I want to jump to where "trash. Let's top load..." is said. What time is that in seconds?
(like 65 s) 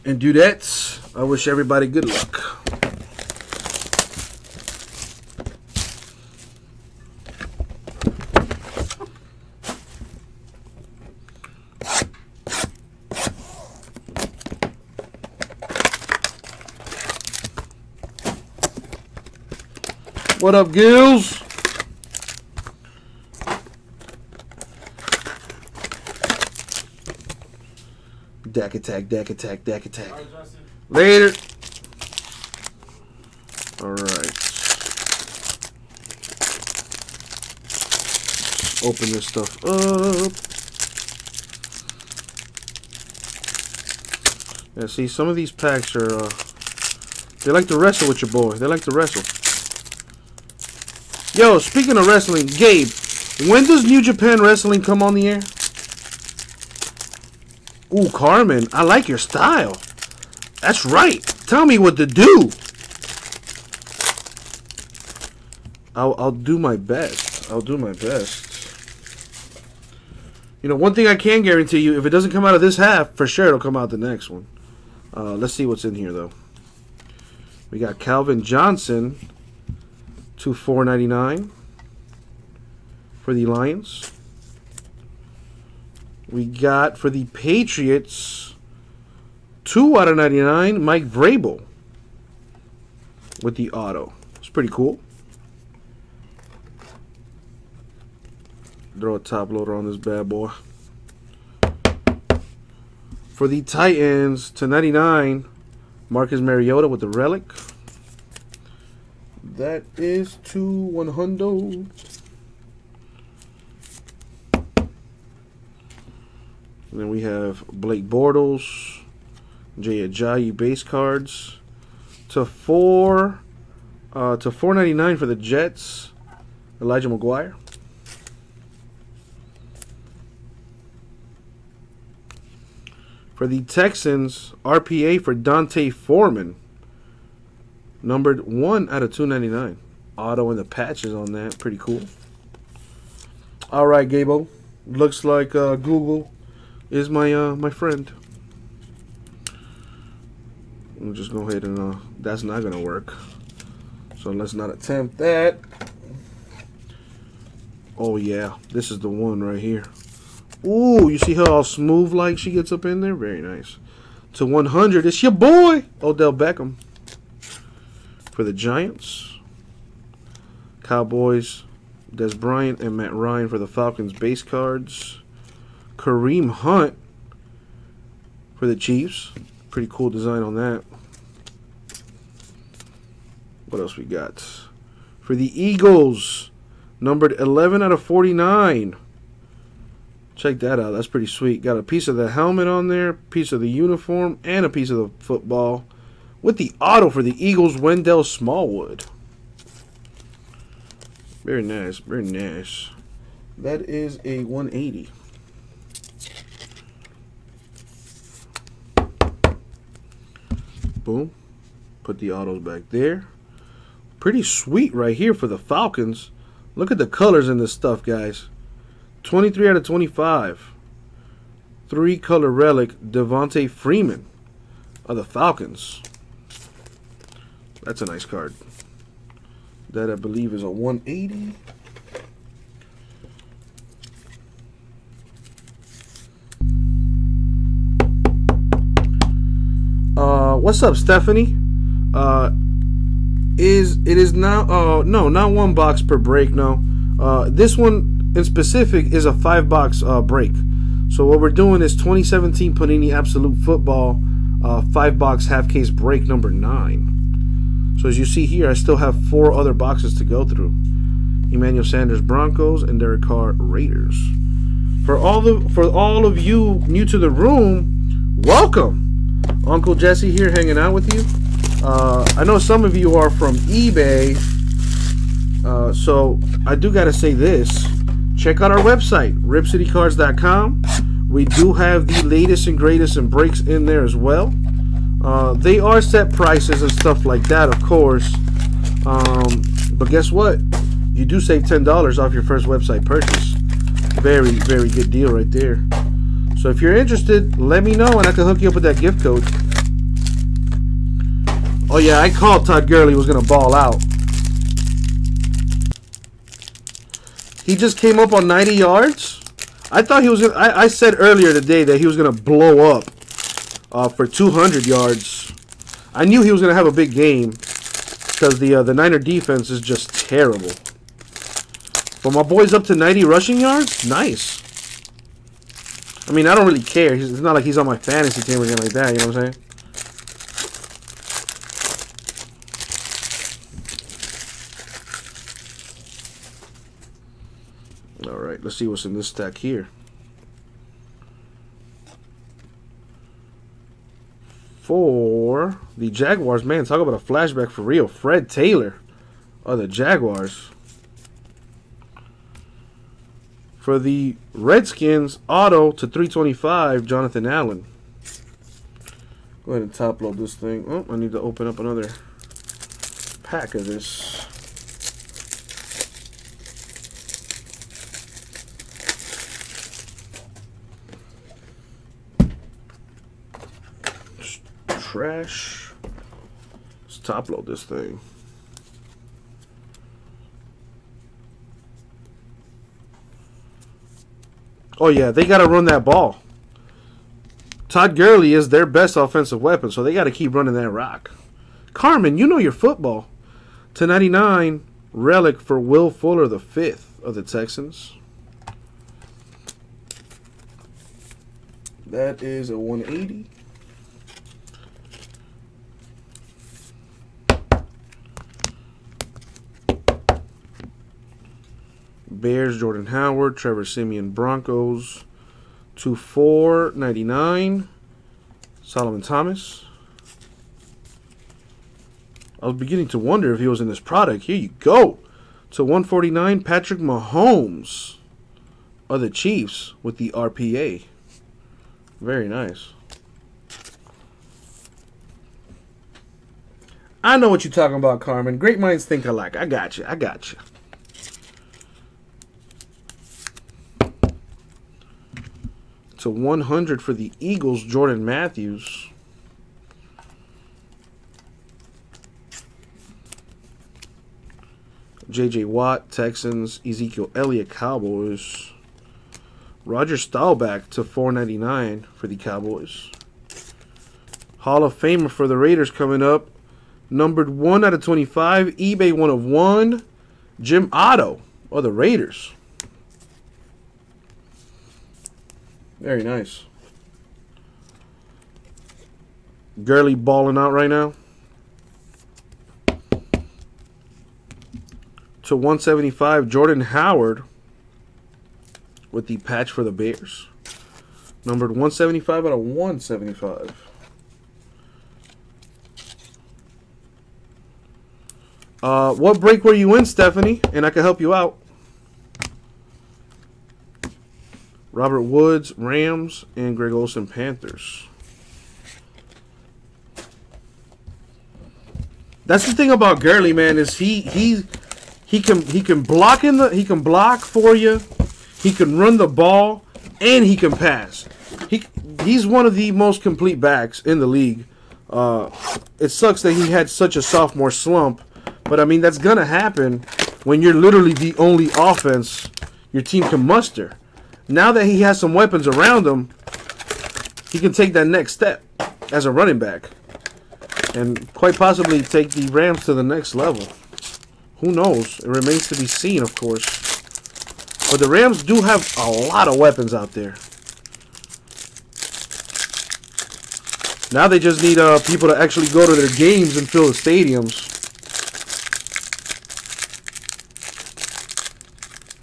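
375 s.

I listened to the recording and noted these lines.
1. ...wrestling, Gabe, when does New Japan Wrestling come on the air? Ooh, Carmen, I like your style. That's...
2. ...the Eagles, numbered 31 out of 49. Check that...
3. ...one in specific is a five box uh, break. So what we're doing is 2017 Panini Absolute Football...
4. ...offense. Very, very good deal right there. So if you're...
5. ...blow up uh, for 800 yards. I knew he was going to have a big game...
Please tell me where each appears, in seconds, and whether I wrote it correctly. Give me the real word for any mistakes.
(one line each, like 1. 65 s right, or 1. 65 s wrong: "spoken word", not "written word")
1. 52 s right
2. 185 s wrong: "11", not "31"
3. 247 s right
4. 293 s wrong: "purchase", not "offense"
5. 312 s wrong: "200", not "800".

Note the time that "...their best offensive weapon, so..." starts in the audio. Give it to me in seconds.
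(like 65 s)
388 s.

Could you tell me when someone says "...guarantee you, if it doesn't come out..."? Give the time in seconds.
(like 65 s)
71 s.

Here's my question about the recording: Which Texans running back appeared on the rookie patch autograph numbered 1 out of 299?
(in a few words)
D'Onta Foreman.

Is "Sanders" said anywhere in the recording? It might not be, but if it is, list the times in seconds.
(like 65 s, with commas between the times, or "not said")
261 s.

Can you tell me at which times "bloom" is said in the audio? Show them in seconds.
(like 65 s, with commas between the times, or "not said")
not said.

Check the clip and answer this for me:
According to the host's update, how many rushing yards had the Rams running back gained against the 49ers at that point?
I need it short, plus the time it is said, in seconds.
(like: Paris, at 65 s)
90, at 308 s.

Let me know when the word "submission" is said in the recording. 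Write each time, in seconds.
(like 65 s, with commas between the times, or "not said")
not said.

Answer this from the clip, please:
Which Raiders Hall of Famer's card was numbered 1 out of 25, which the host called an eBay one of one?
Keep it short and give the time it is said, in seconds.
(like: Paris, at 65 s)
Jim Otto, at 470 s.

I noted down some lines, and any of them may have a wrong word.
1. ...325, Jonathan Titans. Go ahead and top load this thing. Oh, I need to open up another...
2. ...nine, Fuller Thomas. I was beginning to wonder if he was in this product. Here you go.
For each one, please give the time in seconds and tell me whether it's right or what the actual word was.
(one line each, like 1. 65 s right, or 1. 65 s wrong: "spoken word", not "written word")
1. 356 s wrong: "Allen", not "Titans"
2. 417 s wrong: "Solomon", not "Fuller".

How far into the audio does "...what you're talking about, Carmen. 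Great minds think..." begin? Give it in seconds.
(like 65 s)
437 s.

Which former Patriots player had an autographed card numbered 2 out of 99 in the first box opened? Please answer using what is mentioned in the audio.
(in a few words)
Mike Vrabel.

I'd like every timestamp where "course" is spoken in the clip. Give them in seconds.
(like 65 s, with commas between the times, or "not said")
287 s, 546 s.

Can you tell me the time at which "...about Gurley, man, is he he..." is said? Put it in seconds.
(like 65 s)
512 s.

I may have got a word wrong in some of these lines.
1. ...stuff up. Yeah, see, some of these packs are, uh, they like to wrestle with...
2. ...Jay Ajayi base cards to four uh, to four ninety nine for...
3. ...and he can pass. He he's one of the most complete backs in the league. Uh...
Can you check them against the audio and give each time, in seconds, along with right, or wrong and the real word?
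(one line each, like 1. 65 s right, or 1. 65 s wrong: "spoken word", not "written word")
1. 39 s right
2. 119 s right
3. 520 s right.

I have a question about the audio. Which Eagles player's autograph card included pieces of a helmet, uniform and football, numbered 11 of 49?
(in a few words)
Wendell Smallwood.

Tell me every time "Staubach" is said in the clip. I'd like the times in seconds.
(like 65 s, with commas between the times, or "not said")
460 s.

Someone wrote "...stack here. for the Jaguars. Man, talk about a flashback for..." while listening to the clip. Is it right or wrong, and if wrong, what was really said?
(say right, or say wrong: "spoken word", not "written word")
right.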